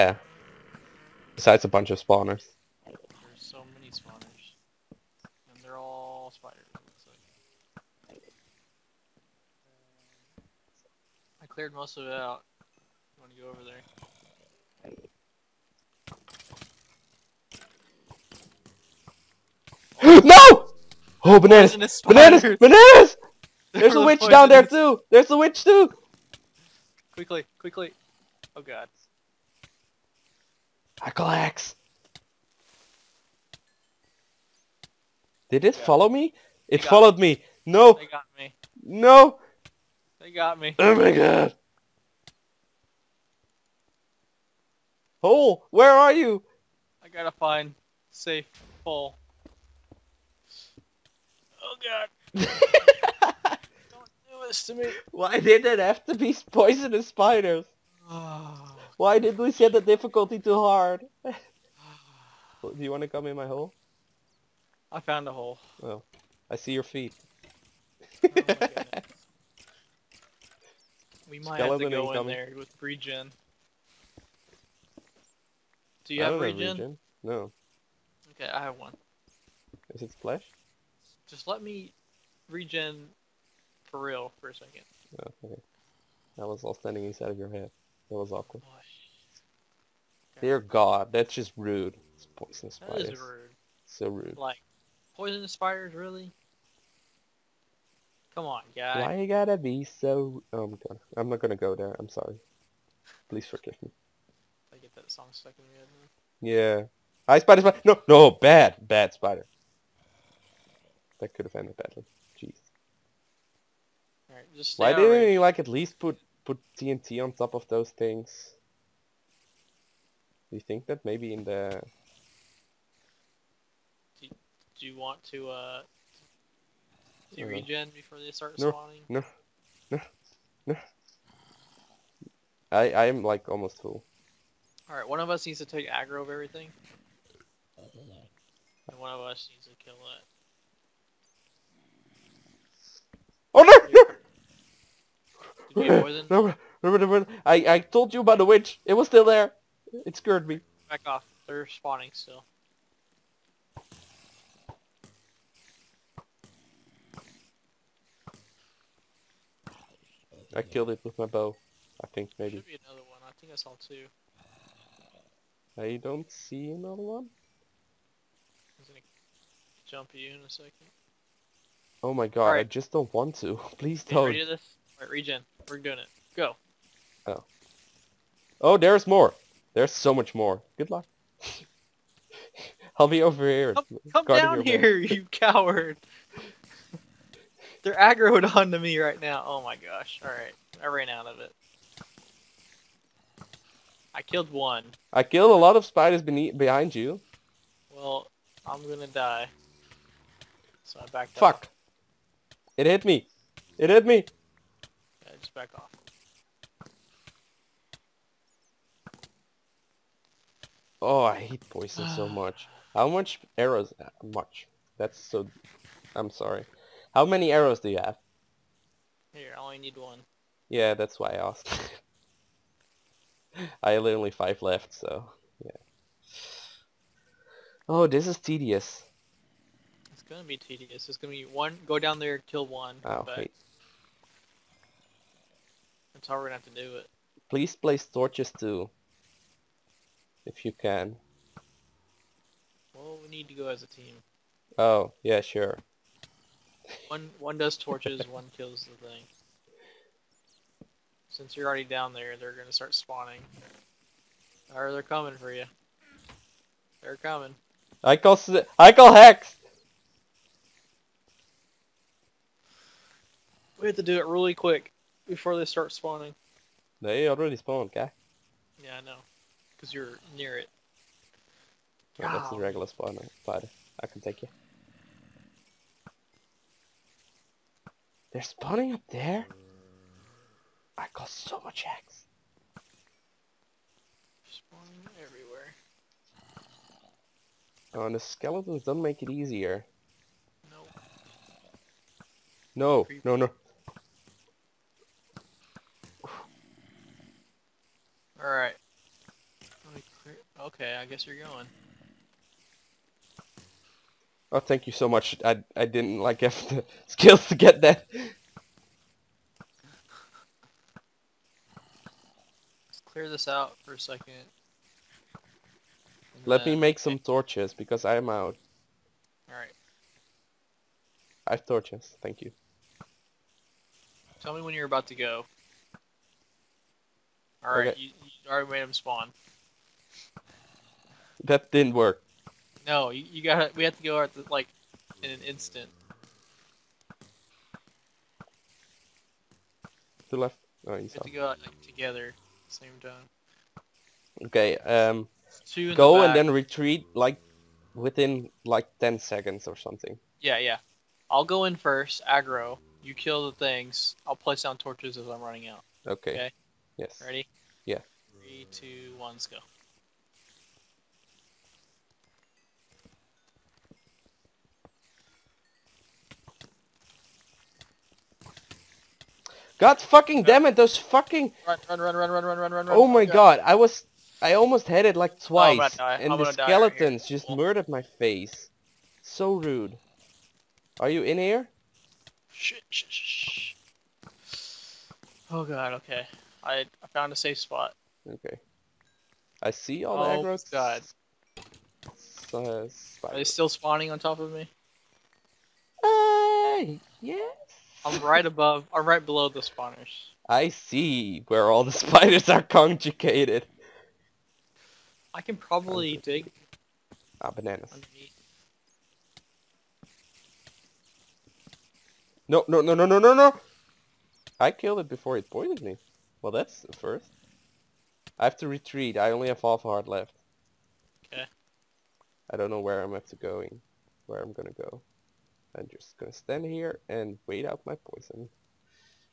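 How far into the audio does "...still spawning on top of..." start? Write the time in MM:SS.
06:33.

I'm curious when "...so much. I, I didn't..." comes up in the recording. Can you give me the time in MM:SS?
05:04.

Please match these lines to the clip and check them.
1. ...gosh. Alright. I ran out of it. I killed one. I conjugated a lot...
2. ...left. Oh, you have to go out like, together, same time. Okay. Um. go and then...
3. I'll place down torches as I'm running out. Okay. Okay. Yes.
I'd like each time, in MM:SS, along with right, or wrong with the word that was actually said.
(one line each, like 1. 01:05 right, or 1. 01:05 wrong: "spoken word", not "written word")
1. 03:09 wrong: "killed", not "conjugated"
2. 05:40 right
3. 05:54 right.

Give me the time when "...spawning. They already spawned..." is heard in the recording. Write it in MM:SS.
04:25.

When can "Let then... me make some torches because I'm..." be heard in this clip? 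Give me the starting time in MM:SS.
05:16.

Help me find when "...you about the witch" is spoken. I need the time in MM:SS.
02:28.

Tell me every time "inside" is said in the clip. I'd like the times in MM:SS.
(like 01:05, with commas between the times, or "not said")
01:27.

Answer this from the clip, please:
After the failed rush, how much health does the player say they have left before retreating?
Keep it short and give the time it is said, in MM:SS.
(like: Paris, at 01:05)
Half a heart, at 06:59.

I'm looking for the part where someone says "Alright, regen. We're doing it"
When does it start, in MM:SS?
02:55.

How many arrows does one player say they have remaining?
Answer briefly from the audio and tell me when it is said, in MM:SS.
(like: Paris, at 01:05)
5, at 03:44.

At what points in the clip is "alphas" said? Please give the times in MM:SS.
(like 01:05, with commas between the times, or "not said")
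not said.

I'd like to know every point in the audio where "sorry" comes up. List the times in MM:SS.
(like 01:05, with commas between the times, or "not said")
01:42, 03:36.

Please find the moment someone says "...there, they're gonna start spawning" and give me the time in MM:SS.
04:12.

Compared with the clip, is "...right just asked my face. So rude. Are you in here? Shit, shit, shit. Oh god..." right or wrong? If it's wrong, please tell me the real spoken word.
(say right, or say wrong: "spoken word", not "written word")
wrong: "murdered", not "asked".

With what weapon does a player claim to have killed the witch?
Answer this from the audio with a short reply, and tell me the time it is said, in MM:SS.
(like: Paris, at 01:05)
Bow, at 02:41.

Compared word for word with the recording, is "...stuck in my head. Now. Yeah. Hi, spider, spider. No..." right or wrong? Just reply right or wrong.
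right.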